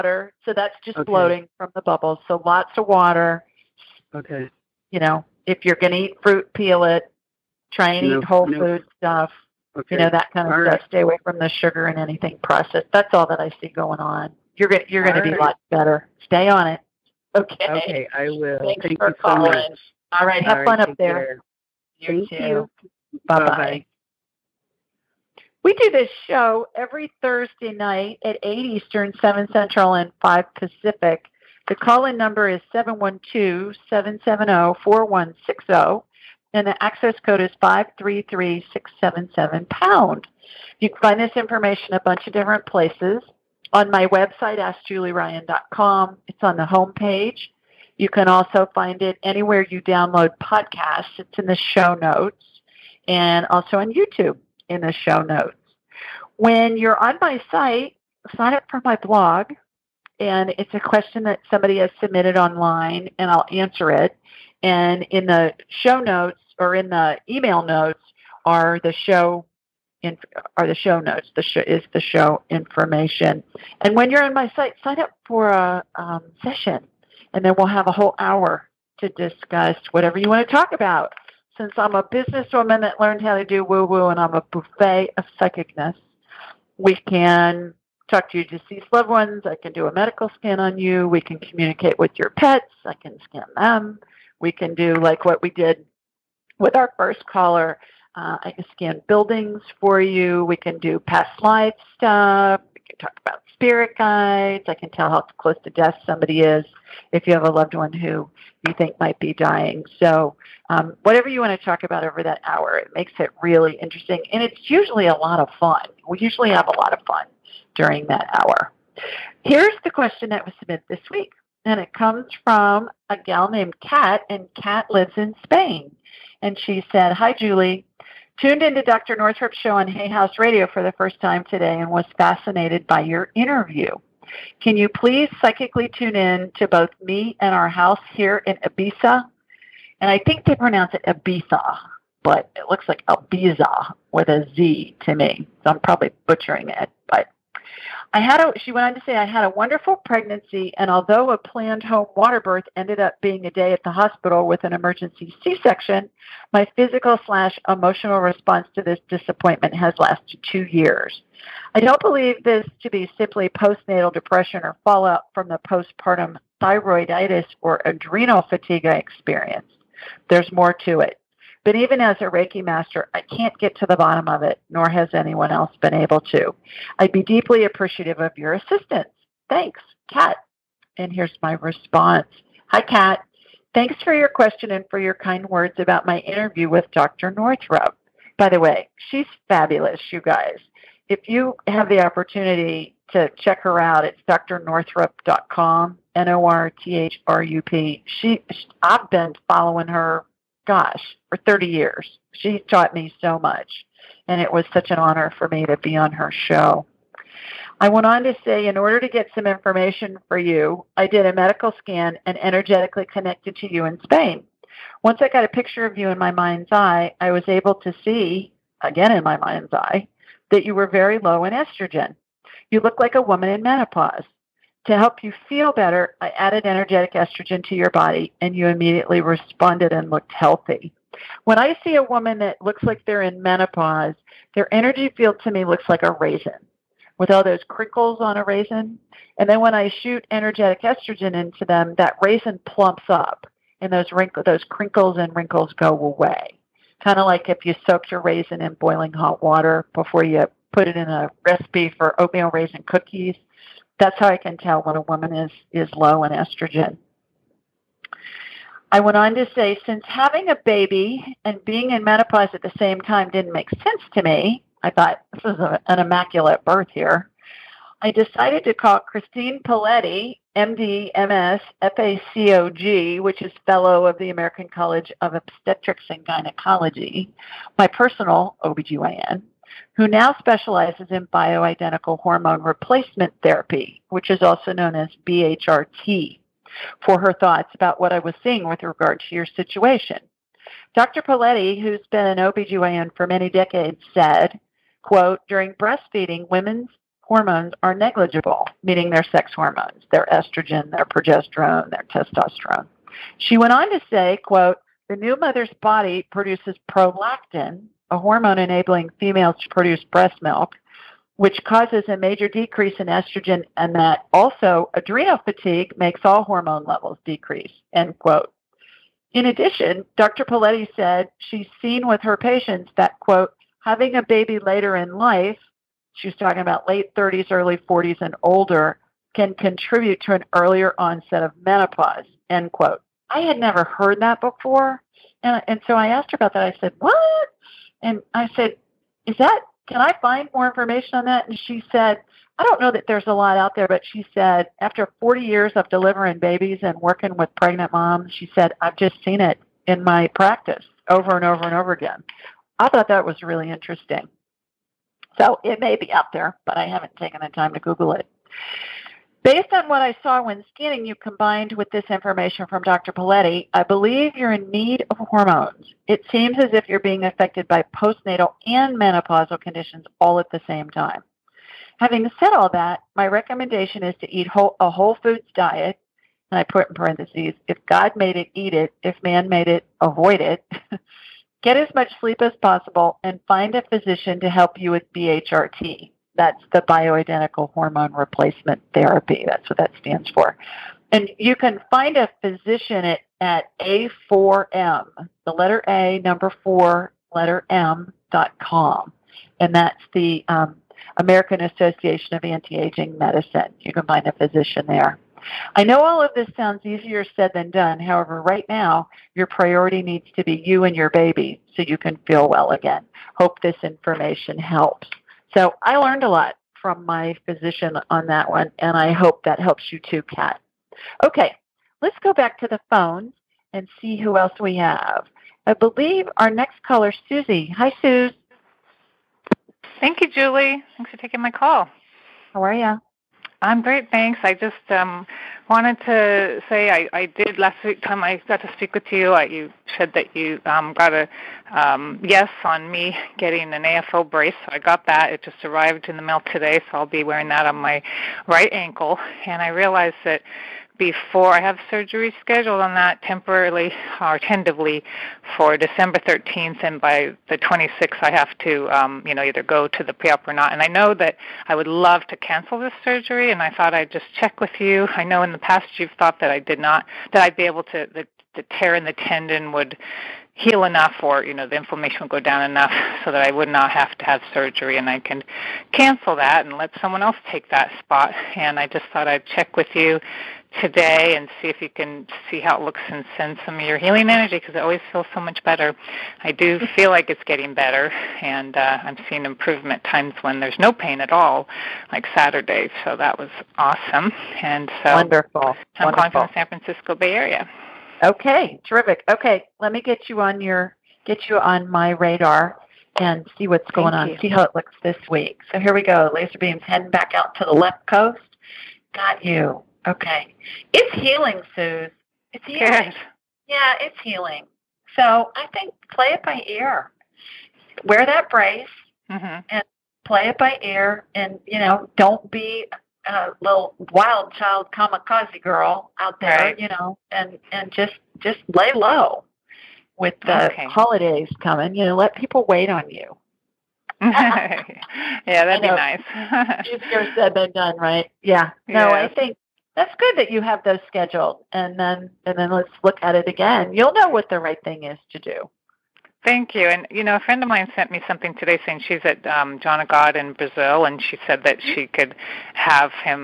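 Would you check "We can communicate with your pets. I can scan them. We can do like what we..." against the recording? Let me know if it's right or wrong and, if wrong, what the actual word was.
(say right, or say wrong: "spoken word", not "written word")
right.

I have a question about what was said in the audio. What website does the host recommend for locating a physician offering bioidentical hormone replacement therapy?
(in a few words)
A4M.com.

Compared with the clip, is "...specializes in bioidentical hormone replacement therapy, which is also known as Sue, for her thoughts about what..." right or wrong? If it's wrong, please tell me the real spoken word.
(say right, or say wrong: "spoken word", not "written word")
wrong: "BHRT", not "Sue".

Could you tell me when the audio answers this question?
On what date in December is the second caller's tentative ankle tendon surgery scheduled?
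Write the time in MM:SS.
07:35.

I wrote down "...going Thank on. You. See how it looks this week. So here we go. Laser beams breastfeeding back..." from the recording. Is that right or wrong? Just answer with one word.
wrong.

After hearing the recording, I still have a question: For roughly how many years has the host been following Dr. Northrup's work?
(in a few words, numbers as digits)
30.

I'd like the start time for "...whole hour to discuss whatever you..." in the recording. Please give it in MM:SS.
01:17.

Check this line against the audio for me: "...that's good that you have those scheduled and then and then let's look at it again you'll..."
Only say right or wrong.
right.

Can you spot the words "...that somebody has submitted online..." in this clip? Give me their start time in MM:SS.
01:01.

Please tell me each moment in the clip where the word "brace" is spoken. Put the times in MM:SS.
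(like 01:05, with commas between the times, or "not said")
07:24, 08:38.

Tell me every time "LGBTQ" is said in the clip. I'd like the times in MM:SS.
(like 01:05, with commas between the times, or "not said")
not said.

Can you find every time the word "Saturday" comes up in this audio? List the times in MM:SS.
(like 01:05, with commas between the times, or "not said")
08:12.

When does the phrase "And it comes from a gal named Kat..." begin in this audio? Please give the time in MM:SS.
02:01.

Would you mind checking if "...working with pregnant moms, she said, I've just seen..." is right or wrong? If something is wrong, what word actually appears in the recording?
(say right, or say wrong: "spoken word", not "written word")
right.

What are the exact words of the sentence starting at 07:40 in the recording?
And I know that I would love to cancel this surgery, and I thought I'd just check with you.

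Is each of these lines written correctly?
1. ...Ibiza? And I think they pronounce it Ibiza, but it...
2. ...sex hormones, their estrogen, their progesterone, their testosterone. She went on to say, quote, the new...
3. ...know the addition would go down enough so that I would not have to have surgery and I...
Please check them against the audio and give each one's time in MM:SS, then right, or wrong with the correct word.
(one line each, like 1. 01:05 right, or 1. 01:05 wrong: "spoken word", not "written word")
1. 02:18 right
2. 04:59 right
3. 07:51 wrong: "inflammation", not "addition".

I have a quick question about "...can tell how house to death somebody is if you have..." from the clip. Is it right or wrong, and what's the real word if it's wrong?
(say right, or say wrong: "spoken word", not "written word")
wrong: "close", not "house".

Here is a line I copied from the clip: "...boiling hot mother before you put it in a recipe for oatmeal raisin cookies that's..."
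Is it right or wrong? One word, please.
wrong.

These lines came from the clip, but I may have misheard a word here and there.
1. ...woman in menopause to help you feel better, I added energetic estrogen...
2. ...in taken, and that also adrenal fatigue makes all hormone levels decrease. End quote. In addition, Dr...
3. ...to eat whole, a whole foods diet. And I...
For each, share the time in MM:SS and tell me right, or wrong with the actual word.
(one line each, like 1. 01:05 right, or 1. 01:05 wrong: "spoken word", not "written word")
1. 03:43 right
2. 05:12 wrong: "estrogen", not "taken"
3. 06:14 right.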